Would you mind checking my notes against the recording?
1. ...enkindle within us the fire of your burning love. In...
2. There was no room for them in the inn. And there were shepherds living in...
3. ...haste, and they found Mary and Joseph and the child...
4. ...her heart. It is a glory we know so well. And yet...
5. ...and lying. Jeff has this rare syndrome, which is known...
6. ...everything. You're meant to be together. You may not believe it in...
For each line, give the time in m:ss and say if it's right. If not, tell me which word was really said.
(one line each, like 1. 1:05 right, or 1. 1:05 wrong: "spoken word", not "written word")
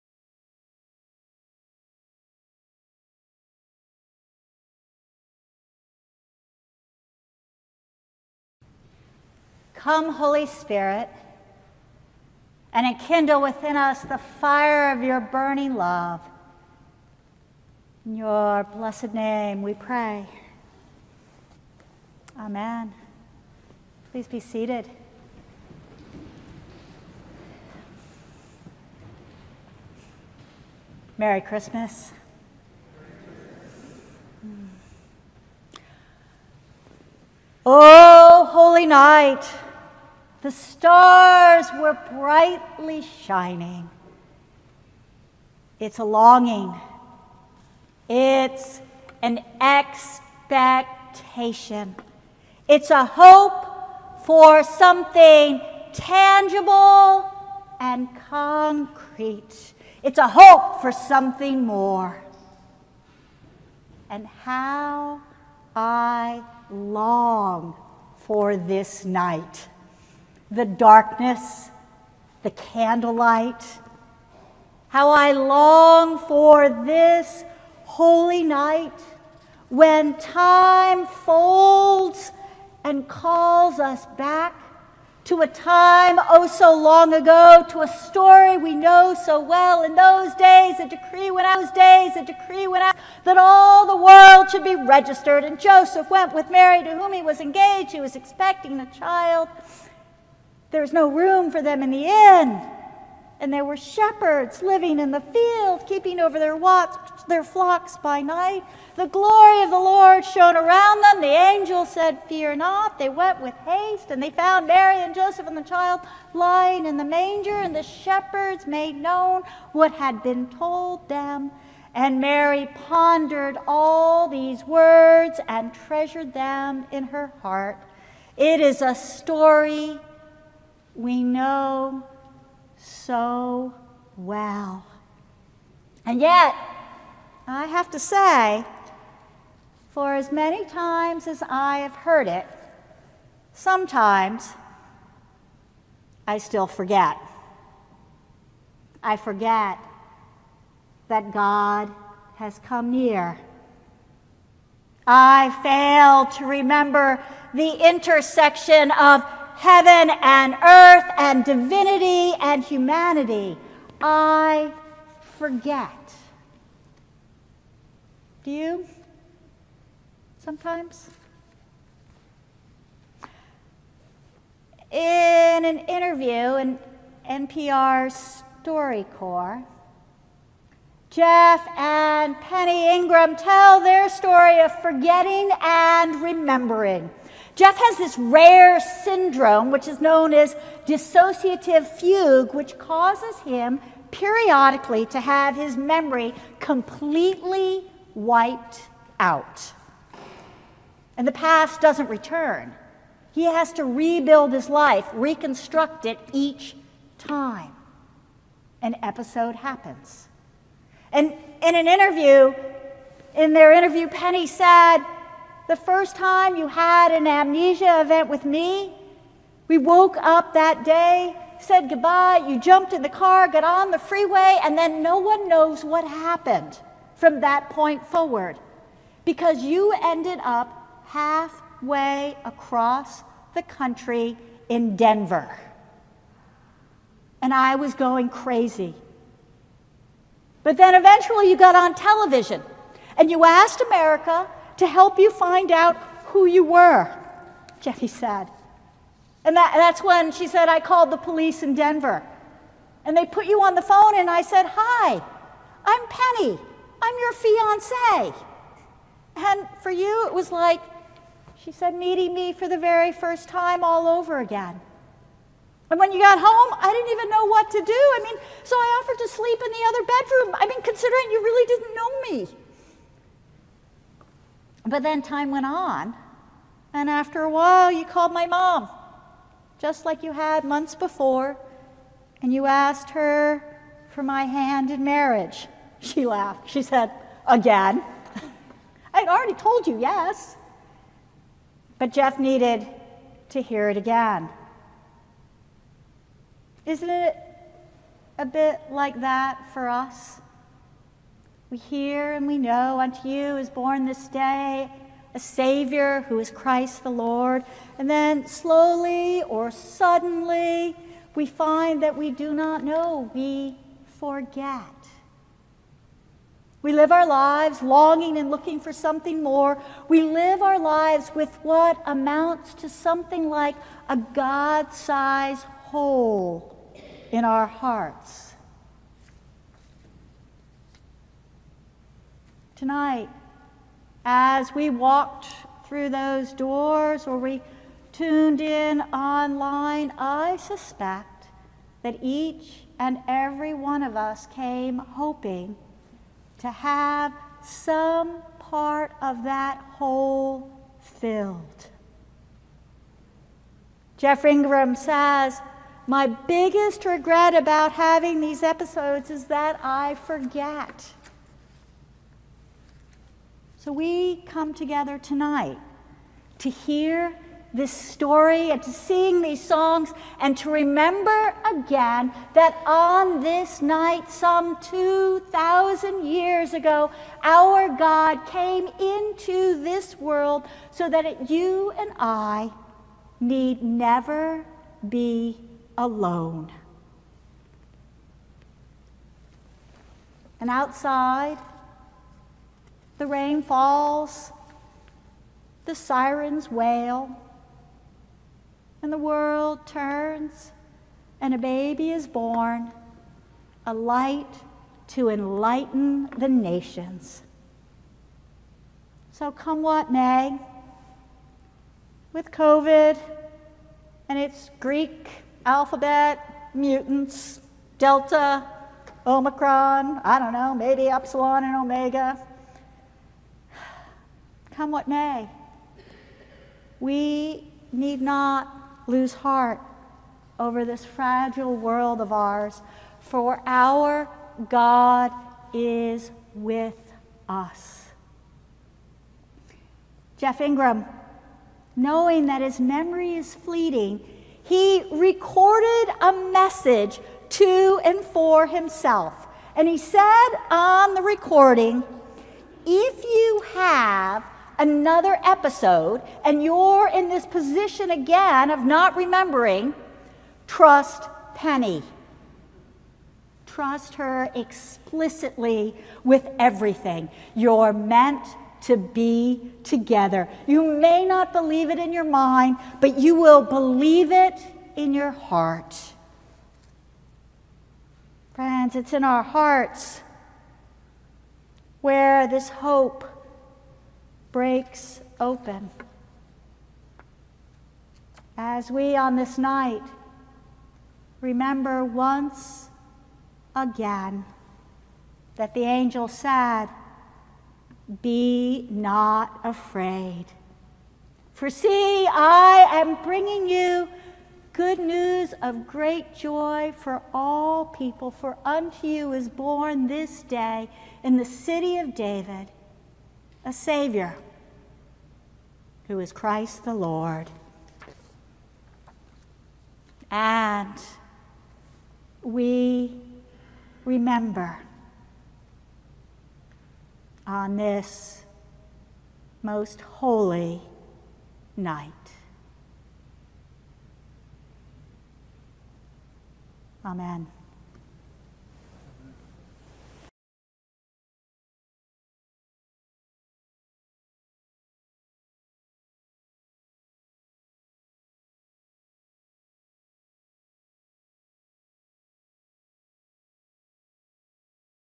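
1. 0:12 right
2. 1:40 right
3. 1:53 right
4. 2:07 wrong: "story", not "glory"
5. 3:05 wrong: "remembering", not "lying"
6. 7:46 right.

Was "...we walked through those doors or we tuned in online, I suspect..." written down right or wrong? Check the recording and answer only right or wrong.
right.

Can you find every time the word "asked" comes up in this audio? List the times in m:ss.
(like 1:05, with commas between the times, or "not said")
4:03, 4:42.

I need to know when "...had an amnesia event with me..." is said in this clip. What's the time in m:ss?
3:36.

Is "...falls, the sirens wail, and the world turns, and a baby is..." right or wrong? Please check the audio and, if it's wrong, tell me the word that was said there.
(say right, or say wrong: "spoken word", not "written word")
right.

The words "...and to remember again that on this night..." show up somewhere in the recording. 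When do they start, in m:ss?
6:10.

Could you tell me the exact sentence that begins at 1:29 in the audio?
In those days, a decree went out, those days, a decree went out that all the world should be registered.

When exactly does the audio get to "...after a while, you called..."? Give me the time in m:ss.
4:37.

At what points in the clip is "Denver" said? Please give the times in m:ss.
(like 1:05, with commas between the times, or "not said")
3:54, 4:11.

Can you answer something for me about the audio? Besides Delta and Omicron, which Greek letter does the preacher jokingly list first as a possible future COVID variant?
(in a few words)
Epsilon.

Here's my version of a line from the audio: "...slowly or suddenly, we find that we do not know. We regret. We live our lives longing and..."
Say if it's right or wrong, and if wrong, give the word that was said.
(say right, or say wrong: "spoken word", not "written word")
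wrong: "forget", not "regret".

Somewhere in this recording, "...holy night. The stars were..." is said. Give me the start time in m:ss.
0:38.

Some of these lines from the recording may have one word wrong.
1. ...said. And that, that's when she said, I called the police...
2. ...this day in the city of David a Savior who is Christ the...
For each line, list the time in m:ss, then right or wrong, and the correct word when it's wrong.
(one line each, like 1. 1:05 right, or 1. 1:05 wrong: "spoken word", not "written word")
1. 4:08 right
2. 8:30 right.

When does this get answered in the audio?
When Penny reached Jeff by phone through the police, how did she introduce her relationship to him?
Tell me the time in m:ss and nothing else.
4:17.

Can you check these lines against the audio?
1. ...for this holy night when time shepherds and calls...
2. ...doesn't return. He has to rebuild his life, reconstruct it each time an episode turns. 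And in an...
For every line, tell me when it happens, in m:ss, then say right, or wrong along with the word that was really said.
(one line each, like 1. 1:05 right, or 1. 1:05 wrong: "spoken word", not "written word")
1. 1:16 wrong: "folds", not "shepherds"
2. 3:21 wrong: "happens", not "turns".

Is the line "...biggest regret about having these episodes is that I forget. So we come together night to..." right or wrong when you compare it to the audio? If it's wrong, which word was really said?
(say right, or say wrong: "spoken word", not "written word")
wrong: "tonight", not "night".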